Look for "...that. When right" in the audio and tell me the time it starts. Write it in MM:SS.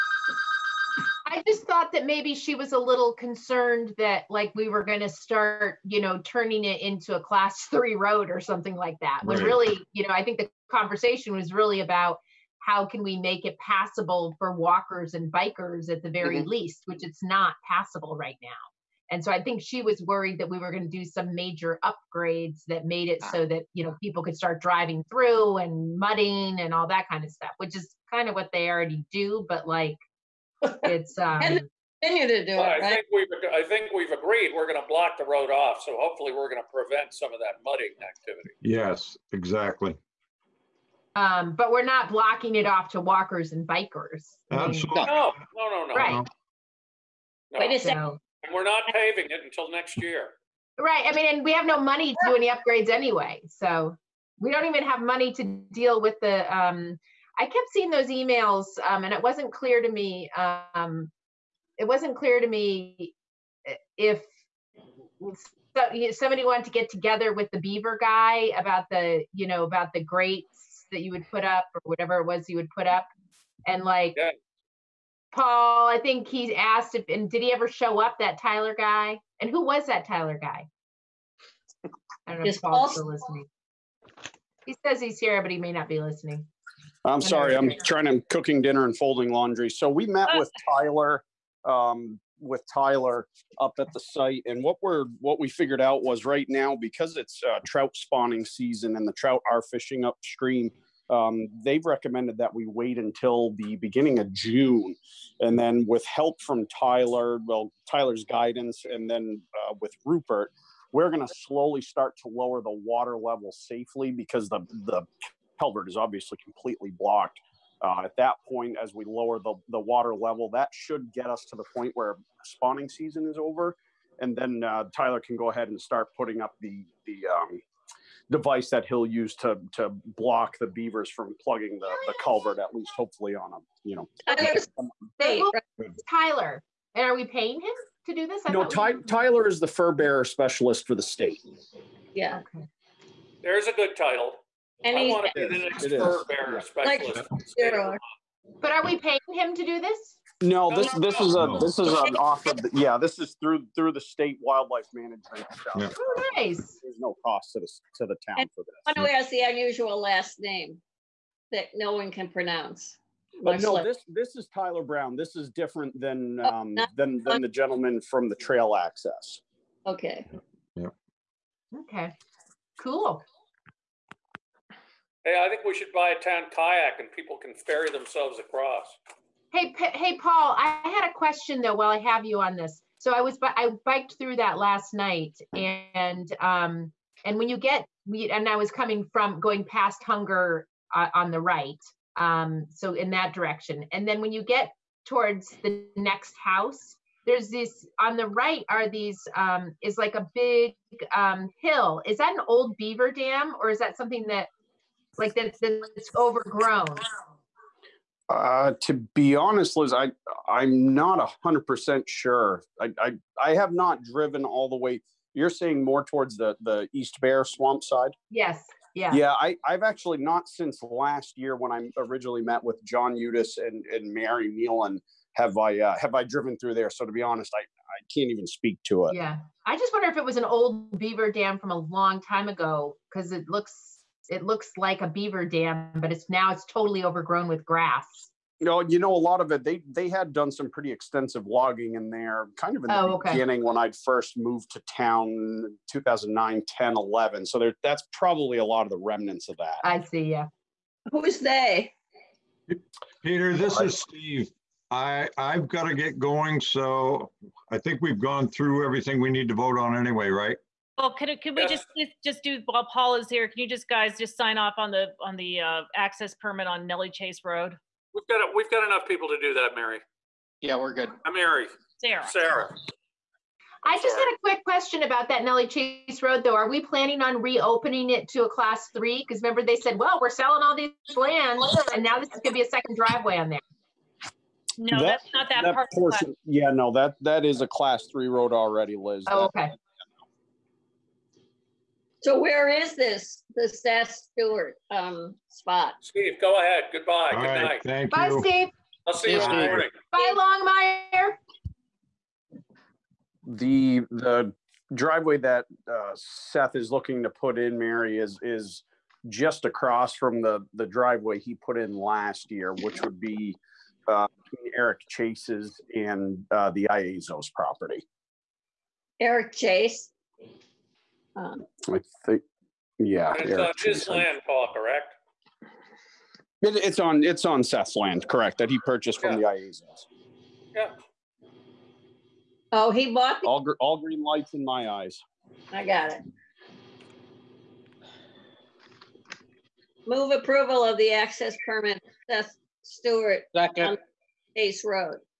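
00:09.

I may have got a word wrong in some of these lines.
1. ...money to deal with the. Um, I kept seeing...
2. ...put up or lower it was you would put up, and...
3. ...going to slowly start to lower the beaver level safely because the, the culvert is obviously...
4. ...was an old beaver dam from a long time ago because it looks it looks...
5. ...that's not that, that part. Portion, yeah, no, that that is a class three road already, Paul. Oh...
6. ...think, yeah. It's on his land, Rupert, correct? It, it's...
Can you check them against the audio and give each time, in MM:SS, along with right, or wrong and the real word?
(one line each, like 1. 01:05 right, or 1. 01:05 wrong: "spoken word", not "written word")
1. 00:54 right
2. 01:11 wrong: "whatever", not "lower"
3. 01:51 wrong: "water", not "beaver"
4. 03:50 right
5. 04:45 wrong: "Liz", not "Paul"
6. 05:22 wrong: "Paul", not "Rupert".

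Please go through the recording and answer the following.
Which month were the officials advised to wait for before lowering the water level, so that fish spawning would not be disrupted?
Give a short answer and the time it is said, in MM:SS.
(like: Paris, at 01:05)
June, at 01:44.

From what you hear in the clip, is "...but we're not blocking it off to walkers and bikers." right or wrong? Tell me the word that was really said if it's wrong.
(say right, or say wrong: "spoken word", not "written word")
right.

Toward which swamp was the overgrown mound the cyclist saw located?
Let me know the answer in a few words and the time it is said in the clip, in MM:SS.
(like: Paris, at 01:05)
East Bear Swamp, at 03:36.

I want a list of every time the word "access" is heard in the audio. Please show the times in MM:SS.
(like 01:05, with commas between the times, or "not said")
02:48, 04:25, 05:41.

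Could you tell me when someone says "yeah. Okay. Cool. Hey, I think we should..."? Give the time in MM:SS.
02:51.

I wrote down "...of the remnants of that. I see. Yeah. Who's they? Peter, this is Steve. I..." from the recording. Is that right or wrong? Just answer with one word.
right.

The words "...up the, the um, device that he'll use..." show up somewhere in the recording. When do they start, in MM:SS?
02:06.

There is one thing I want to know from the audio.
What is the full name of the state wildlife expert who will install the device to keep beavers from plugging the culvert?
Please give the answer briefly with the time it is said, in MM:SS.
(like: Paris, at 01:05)
Tyler Brown, at 02:44.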